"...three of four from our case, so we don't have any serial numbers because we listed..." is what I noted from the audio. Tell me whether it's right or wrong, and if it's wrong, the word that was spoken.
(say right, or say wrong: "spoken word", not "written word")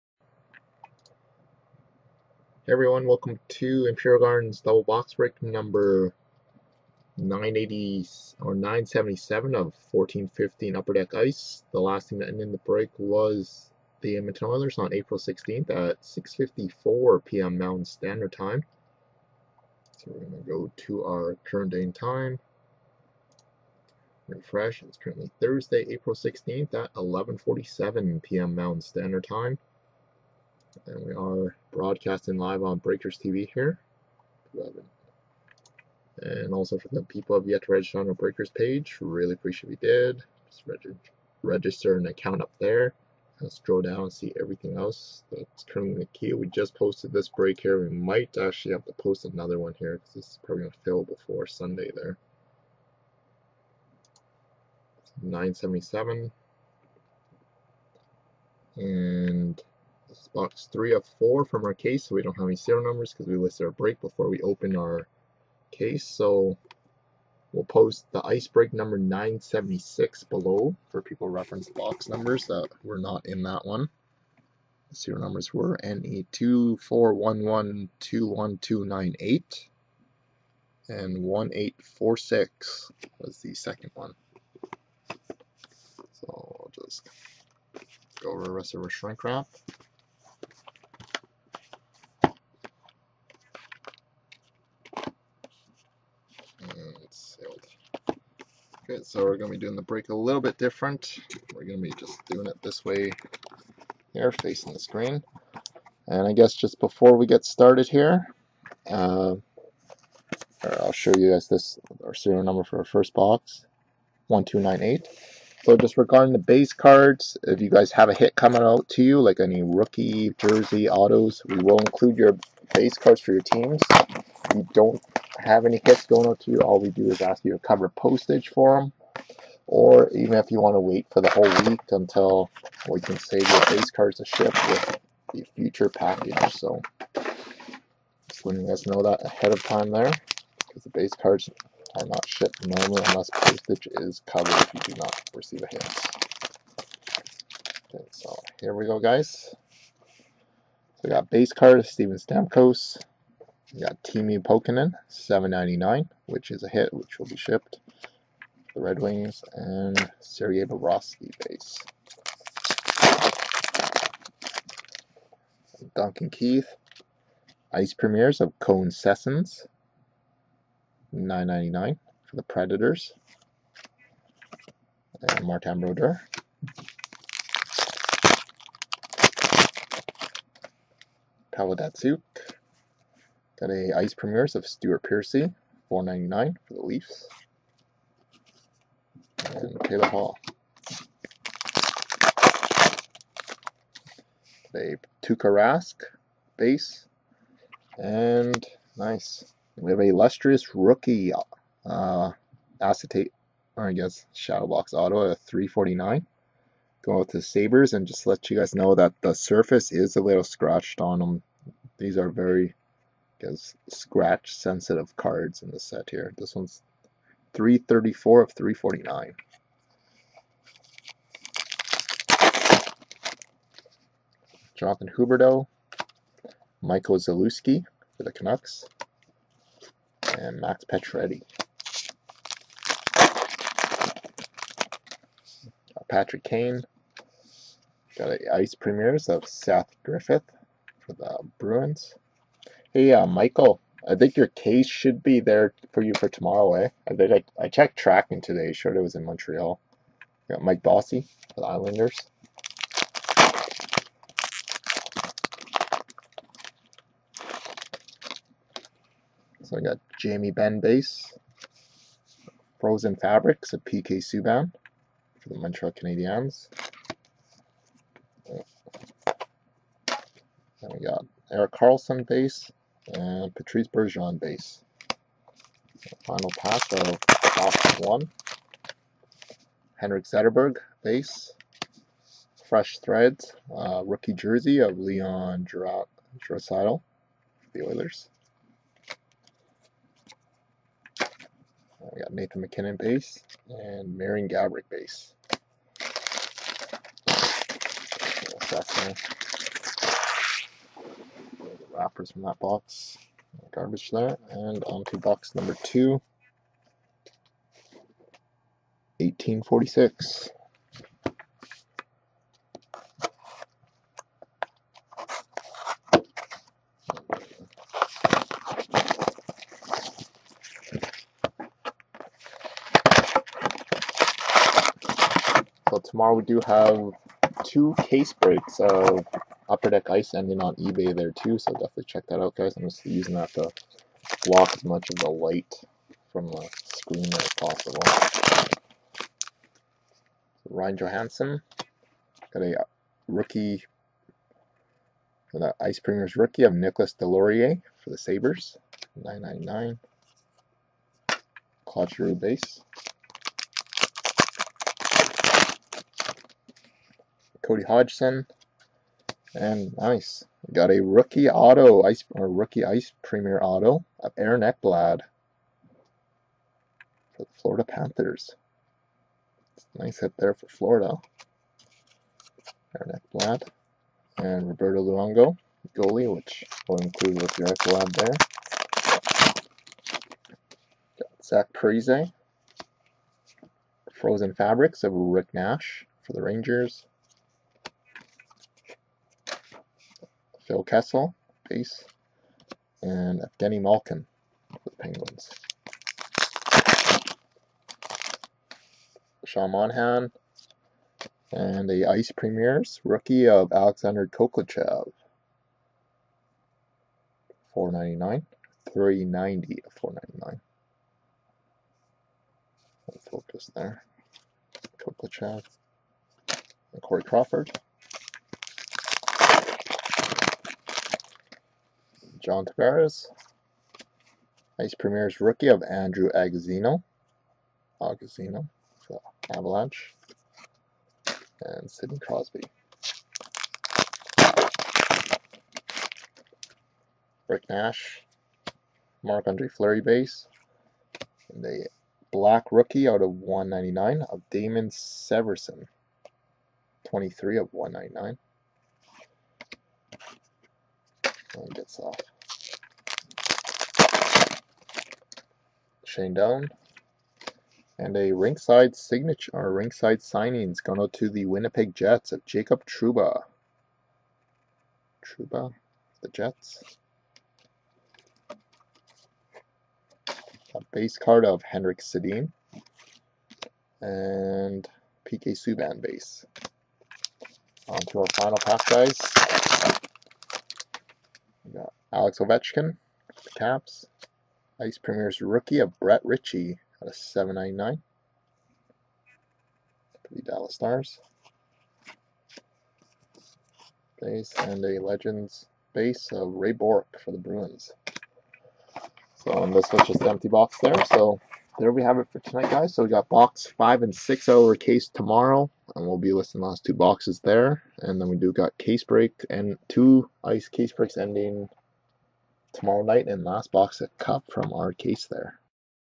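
right.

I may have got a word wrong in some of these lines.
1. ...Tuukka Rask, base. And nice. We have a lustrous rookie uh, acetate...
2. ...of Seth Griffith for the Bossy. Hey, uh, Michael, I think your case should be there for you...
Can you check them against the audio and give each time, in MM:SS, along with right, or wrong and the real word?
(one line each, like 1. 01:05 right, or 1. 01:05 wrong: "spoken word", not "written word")
1. 03:15 right
2. 03:59 wrong: "Bruins", not "Bossy".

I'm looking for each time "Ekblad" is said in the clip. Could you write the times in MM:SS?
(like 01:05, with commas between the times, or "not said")
06:04, 06:13, 06:17.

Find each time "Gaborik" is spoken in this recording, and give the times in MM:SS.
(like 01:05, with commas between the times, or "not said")
04:54.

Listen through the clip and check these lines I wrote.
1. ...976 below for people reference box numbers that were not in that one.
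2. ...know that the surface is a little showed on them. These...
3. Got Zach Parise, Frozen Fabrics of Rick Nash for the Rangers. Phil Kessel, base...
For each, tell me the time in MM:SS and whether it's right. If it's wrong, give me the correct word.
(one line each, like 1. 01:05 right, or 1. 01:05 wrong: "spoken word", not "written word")
1. 01:08 right
2. 03:28 wrong: "scratched", not "showed"
3. 06:21 right.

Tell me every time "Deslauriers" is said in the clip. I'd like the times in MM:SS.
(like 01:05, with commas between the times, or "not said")
05:47.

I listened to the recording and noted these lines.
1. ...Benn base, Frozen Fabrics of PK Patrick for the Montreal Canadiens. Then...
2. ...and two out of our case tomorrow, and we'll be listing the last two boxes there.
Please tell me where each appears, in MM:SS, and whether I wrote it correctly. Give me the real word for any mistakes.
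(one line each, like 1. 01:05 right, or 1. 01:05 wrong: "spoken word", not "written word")
1. 04:20 wrong: "Subban", not "Patrick"
2. 08:24 wrong: "six", not "two".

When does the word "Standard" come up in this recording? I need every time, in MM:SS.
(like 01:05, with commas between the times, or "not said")
00:17, 00:28.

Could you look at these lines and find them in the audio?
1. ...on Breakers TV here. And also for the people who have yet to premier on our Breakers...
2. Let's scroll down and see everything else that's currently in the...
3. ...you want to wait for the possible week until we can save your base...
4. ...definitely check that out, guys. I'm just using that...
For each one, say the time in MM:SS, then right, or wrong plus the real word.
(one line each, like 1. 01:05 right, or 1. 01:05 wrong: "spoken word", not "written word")
1. 00:32 wrong: "register", not "premier"
2. 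00:43 right
3. 02:10 wrong: "whole", not "possible"
4. 05:31 right.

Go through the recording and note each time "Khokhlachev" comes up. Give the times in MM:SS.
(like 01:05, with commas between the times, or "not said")
06:44, 06:54.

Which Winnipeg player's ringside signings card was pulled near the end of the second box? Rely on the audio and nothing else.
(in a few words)
Jacob Trouba.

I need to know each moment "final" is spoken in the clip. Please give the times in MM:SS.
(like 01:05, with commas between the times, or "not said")
04:36, 07:58.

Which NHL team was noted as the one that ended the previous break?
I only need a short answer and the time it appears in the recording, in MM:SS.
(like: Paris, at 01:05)
Edmonton Oilers, at 00:14.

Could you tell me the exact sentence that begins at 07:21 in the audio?
And the black rookie out of 199 of Damon Severson.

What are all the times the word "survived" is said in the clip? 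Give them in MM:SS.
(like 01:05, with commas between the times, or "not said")
not said.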